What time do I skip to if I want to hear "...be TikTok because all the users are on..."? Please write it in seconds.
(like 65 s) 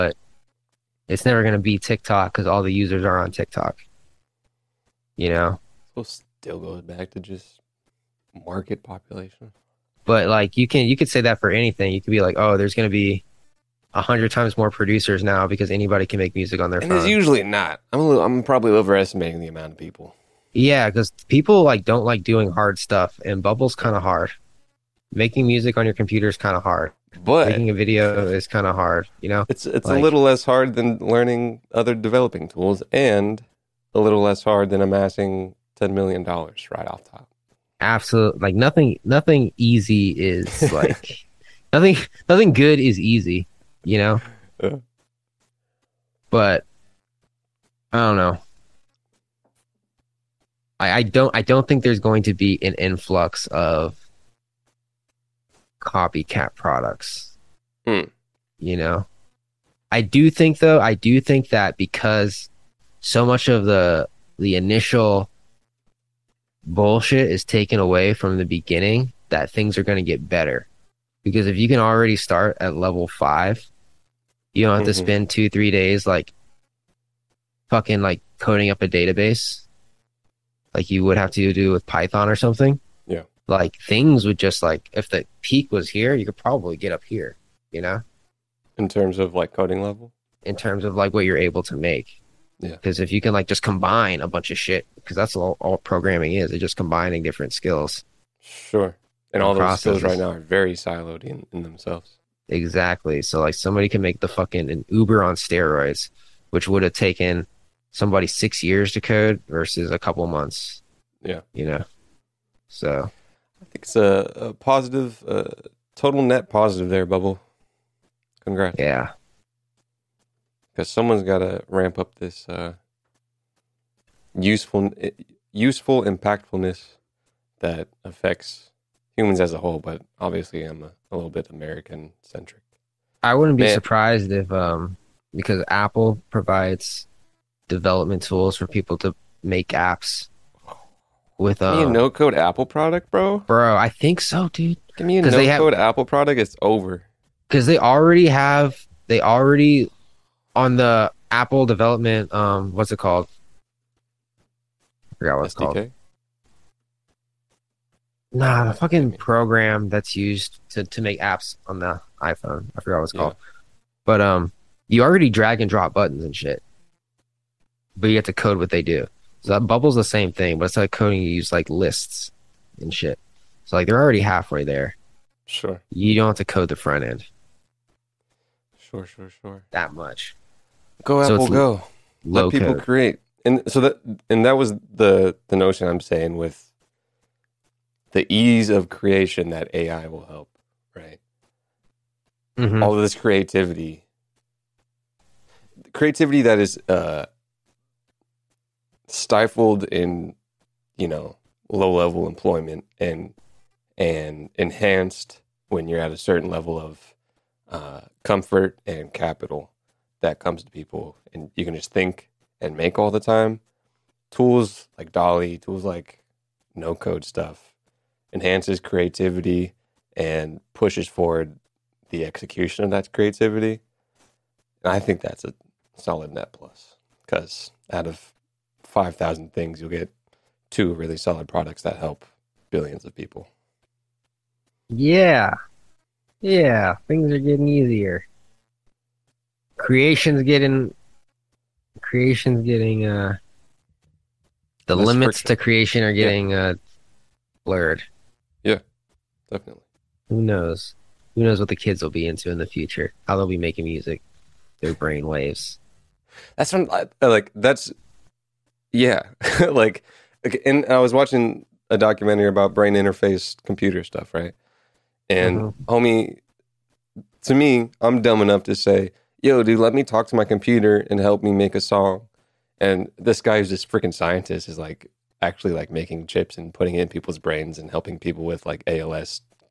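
1 s.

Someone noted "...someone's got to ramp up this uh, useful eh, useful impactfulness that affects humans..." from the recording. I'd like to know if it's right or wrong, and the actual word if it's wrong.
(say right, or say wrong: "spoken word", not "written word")
right.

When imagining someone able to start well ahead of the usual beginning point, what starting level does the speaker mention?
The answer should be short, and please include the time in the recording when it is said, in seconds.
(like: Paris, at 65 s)
level 5, at 72 s.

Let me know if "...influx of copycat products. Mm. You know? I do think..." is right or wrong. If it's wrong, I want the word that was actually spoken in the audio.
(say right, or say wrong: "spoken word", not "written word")
right.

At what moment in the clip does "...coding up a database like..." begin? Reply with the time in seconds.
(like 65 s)
78 s.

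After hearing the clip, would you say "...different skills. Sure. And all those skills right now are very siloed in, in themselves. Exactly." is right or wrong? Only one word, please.
right.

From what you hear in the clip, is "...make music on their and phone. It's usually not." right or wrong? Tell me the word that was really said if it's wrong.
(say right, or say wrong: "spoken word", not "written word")
right.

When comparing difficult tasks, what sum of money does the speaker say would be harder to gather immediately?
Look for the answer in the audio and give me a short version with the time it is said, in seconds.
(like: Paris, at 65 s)
$10,000,000, at 35 s.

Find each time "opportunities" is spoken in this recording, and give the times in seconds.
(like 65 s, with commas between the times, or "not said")
not said.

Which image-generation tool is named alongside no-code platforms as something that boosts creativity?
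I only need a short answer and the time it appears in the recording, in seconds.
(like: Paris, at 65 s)
DALL-E, at 215 s.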